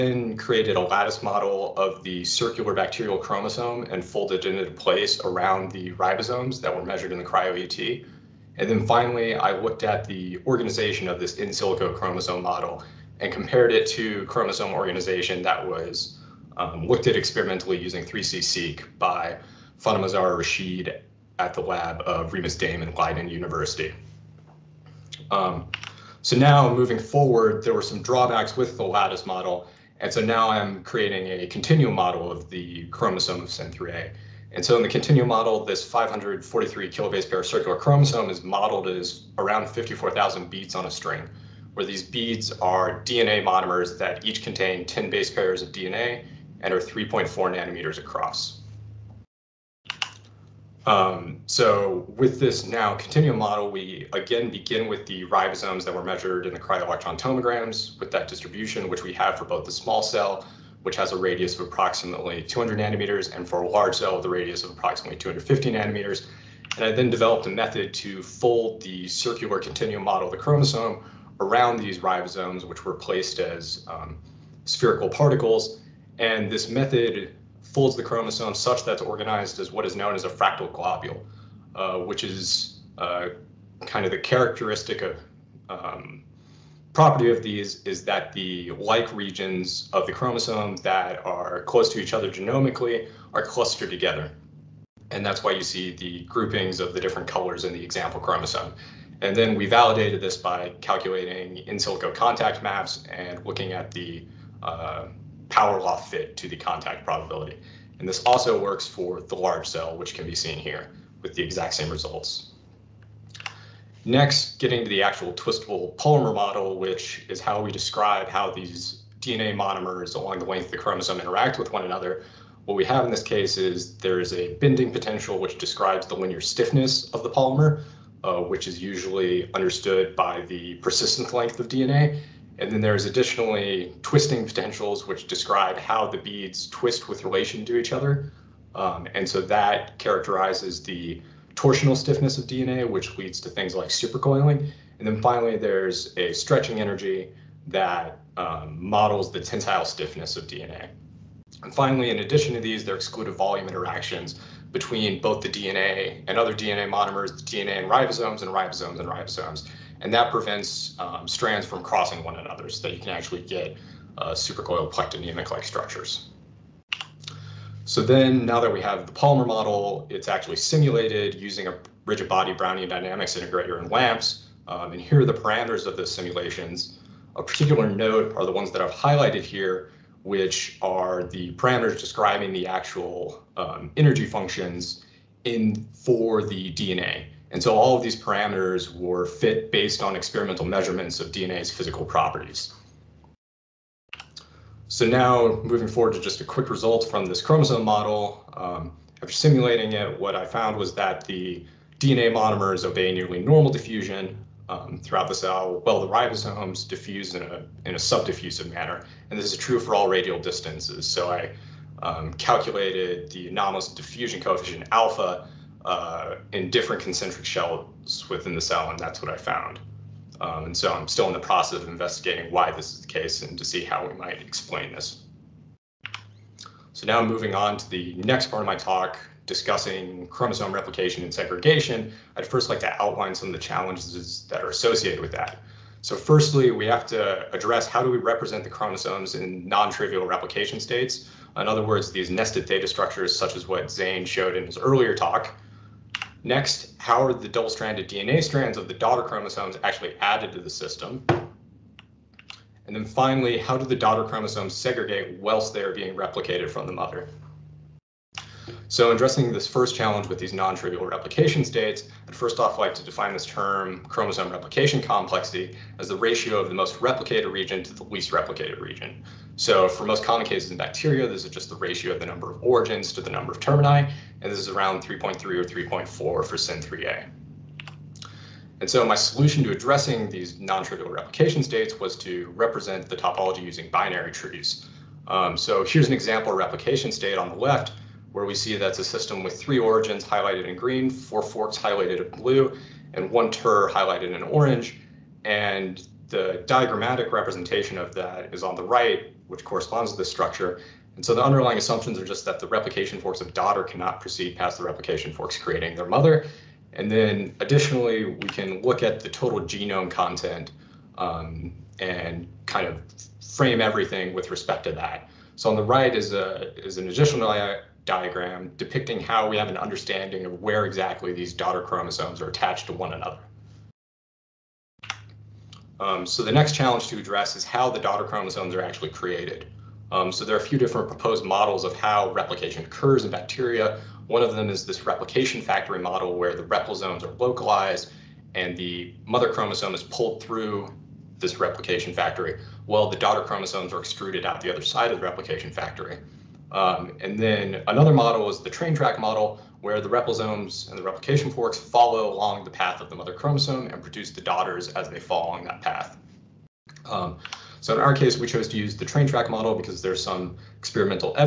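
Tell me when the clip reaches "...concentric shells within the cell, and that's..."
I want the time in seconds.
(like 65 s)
217 s.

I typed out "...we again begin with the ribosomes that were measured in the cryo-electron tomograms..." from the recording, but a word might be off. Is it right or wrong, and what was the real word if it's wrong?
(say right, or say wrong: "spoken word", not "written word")
right.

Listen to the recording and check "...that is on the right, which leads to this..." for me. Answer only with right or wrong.
wrong.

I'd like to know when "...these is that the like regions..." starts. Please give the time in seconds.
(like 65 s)
87 s.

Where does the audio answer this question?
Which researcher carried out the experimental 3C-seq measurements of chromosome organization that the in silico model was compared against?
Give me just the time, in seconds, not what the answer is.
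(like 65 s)
19 s.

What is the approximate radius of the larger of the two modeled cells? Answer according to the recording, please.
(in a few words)
250 nanometers.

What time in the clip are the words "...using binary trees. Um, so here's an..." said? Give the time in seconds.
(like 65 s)
283 s.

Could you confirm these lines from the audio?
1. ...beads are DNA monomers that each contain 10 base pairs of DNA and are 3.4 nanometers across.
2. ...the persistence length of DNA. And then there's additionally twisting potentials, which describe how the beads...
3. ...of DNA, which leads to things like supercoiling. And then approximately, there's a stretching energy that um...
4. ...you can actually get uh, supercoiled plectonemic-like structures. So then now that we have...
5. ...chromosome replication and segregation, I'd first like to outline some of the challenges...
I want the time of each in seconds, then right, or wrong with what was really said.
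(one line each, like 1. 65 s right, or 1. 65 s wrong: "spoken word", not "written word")
1. 42 s right
2. 130 s right
3. 142 s wrong: "finally", not "approximately"
4. 162 s right
5. 230 s right.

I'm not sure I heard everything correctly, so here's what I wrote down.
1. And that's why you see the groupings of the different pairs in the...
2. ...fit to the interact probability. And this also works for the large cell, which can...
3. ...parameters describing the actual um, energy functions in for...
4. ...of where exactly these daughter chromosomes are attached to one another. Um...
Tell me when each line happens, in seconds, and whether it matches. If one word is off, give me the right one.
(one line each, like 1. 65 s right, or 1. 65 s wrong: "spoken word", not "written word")
1. 95 s wrong: "colors", not "pairs"
2. 105 s wrong: "contact", not "interact"
3. 181 s right
4. 320 s right.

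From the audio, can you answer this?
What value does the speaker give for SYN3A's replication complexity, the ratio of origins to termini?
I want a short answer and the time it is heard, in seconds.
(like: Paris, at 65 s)
3.3 or 3.4, at 275 s.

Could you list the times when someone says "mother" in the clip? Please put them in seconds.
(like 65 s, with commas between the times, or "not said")
256 s, 306 s, 339 s, 353 s.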